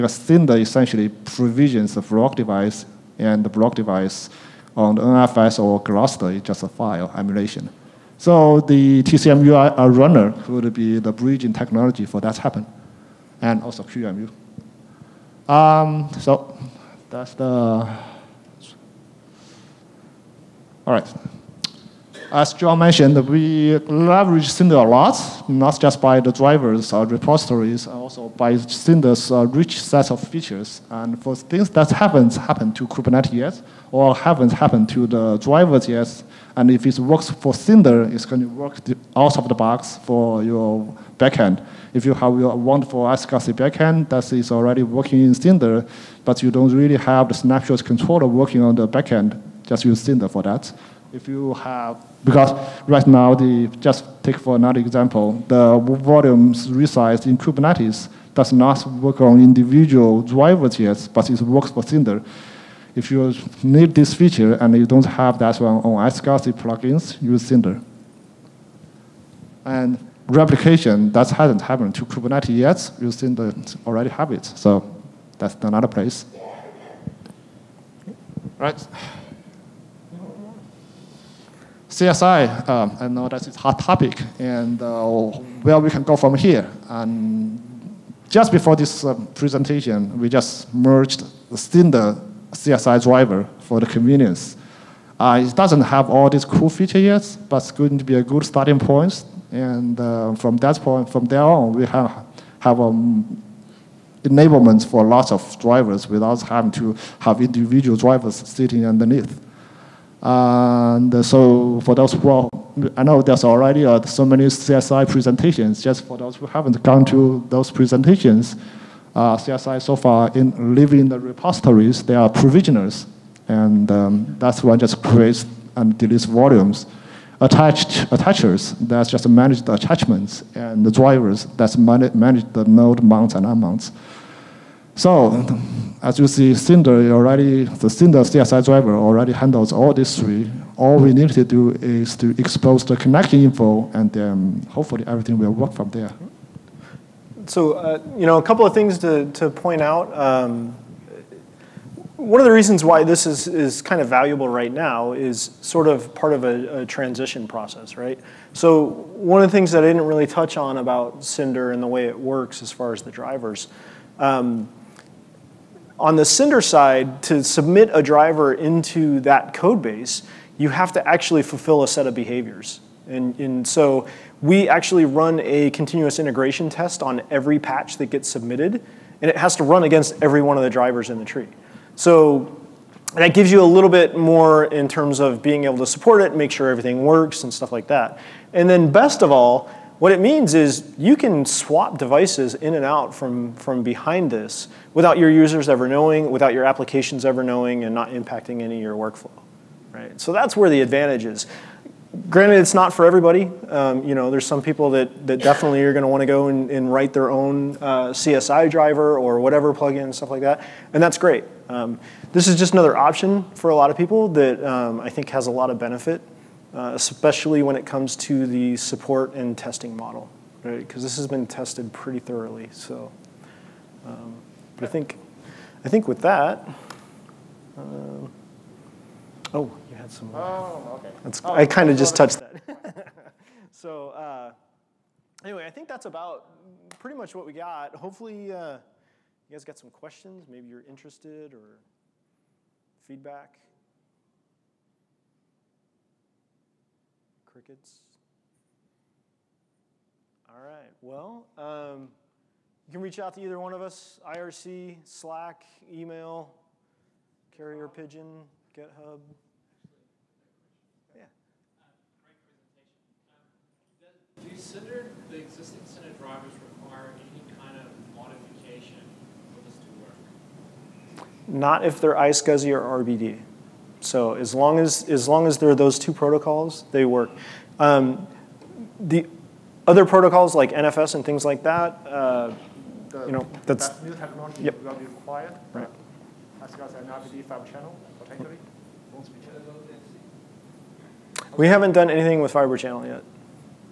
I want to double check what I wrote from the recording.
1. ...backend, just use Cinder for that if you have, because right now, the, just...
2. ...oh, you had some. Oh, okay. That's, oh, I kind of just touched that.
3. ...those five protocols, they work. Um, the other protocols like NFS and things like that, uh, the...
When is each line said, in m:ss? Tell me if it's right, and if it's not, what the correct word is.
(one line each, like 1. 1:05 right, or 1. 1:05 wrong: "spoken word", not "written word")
1. 0:48 right
2. 3:49 right
3. 4:35 wrong: "two", not "five".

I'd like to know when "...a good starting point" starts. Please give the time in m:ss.
1:38.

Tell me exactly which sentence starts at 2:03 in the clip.
And um, that's one just creates and deletes volumes.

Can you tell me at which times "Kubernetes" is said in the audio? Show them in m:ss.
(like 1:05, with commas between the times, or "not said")
0:32, 0:57, 1:12.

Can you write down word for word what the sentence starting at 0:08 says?
So the TCMU uh, runner could be the bridging technology for that happen, and also QEMU.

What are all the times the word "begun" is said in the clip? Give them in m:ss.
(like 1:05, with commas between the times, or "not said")
not said.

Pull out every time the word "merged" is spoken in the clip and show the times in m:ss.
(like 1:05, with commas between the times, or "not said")
1:30.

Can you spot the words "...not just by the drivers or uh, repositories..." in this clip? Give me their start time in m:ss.
0:25.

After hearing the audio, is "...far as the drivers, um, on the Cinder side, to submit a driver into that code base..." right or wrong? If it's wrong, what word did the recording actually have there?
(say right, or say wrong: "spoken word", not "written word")
right.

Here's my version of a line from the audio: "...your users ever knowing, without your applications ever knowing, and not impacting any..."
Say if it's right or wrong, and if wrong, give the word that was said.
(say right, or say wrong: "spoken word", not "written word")
right.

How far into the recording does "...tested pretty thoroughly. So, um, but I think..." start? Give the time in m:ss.
3:41.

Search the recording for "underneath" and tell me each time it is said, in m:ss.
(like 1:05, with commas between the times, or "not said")
1:48.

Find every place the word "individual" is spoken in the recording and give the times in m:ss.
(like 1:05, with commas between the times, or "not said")
0:59, 1:47.